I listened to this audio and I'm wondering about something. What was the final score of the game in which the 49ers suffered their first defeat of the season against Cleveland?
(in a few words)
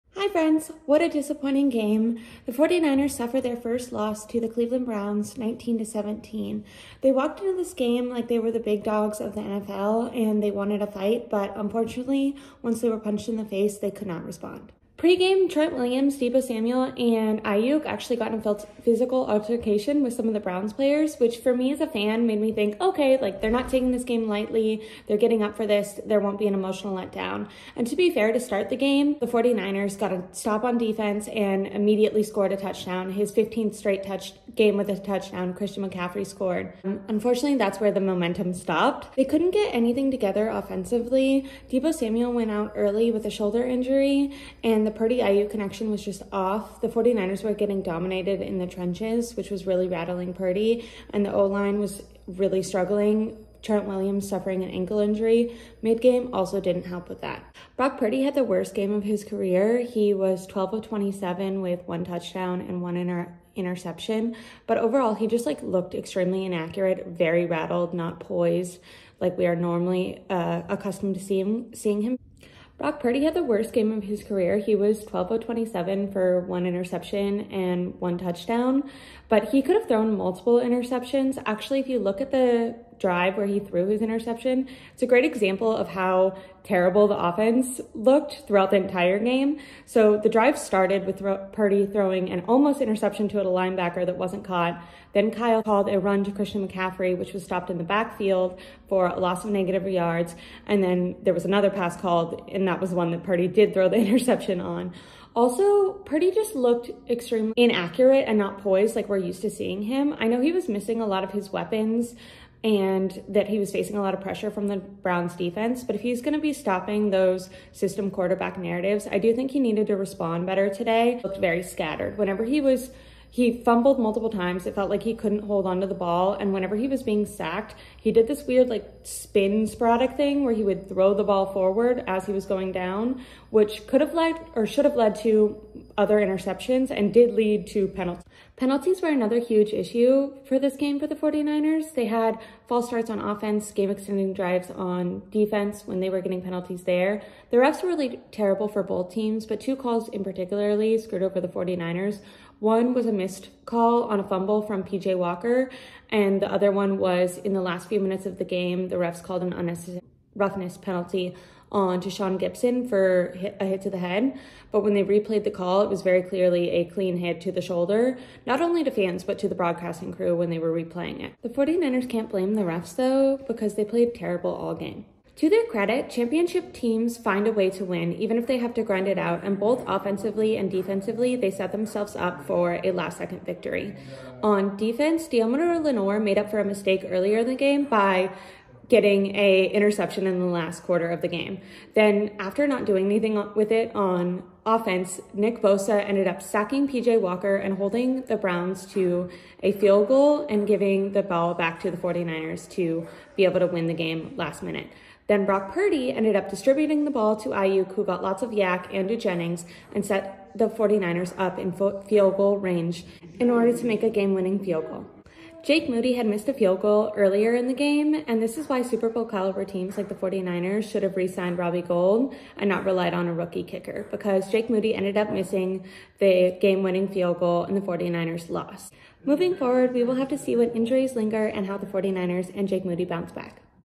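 19 to 17.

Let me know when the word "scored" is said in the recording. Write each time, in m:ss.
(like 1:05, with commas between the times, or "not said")
0:32, 0:36.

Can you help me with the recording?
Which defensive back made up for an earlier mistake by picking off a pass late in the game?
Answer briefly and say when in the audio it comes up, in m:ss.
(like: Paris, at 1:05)
Deommodore Lenoir, at 3:05.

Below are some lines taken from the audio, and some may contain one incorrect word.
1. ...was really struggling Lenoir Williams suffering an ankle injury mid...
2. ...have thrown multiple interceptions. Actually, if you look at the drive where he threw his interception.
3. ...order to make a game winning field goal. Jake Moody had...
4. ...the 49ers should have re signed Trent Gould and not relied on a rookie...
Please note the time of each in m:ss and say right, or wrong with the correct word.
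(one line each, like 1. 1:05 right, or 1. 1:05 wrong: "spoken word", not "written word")
1. 0:51 wrong: "Trent", not "Lenoir"
2. 1:19 right
3. 3:33 right
4. 3:40 wrong: "Robbie", not "Trent".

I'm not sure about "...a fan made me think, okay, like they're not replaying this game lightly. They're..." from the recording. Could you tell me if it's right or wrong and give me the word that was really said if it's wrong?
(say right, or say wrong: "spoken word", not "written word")
wrong: "taking", not "replaying".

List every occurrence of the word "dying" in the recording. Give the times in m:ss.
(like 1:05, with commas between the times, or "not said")
not said.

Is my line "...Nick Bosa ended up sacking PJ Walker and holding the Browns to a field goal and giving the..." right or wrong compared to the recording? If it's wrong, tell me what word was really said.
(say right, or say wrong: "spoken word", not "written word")
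right.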